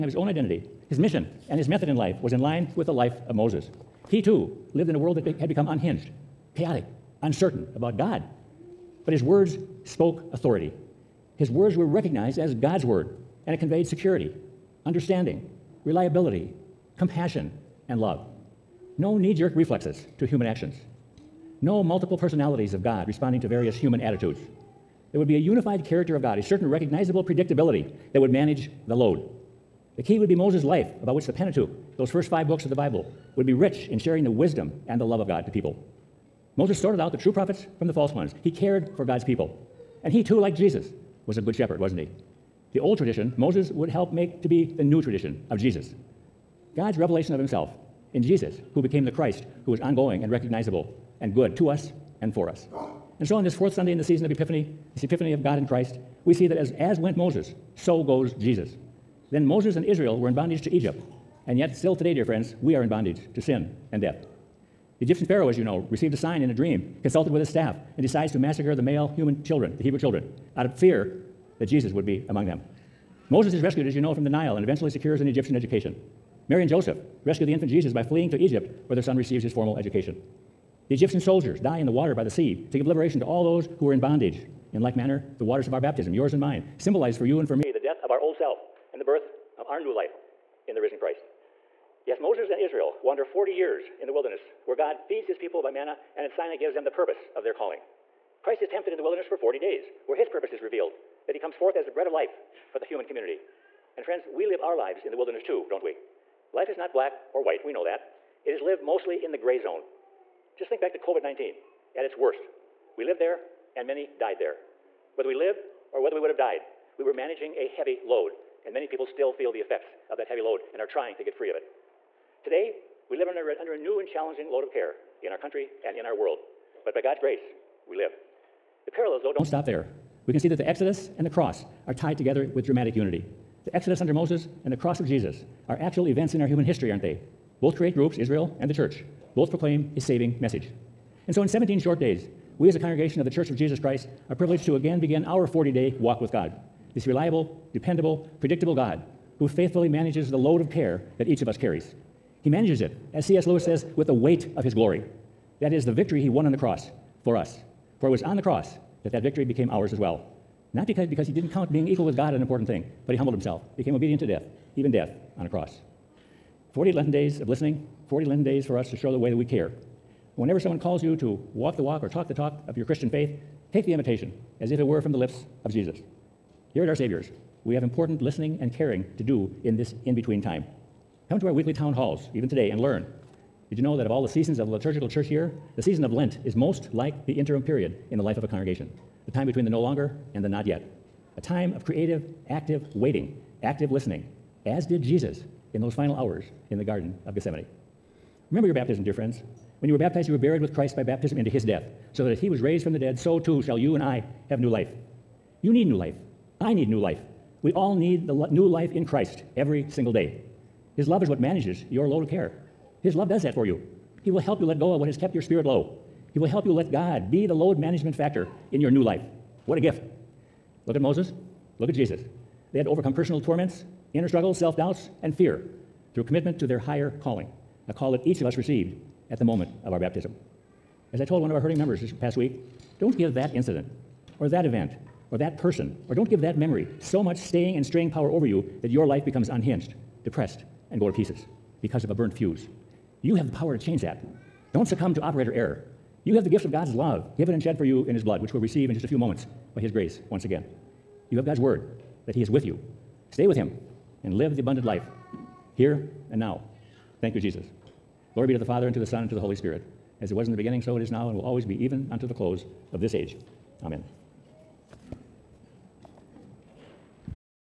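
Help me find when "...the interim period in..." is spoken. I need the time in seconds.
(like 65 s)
187 s.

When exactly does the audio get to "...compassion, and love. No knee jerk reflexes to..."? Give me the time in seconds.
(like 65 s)
16 s.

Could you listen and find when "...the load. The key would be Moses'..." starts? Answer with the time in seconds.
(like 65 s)
28 s.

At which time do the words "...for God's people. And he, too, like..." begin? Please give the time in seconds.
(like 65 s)
38 s.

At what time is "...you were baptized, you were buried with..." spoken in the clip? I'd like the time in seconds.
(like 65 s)
199 s.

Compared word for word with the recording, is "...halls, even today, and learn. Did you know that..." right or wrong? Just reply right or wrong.
right.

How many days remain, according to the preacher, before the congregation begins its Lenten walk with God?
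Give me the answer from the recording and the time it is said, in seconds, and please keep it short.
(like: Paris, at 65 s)
17, at 141 s.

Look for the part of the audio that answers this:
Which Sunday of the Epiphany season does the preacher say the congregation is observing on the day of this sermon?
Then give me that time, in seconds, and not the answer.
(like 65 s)
53 s.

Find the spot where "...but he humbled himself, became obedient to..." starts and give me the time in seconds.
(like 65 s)
163 s.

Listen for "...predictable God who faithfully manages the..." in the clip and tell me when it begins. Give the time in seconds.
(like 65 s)
148 s.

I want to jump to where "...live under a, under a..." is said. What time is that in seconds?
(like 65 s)
123 s.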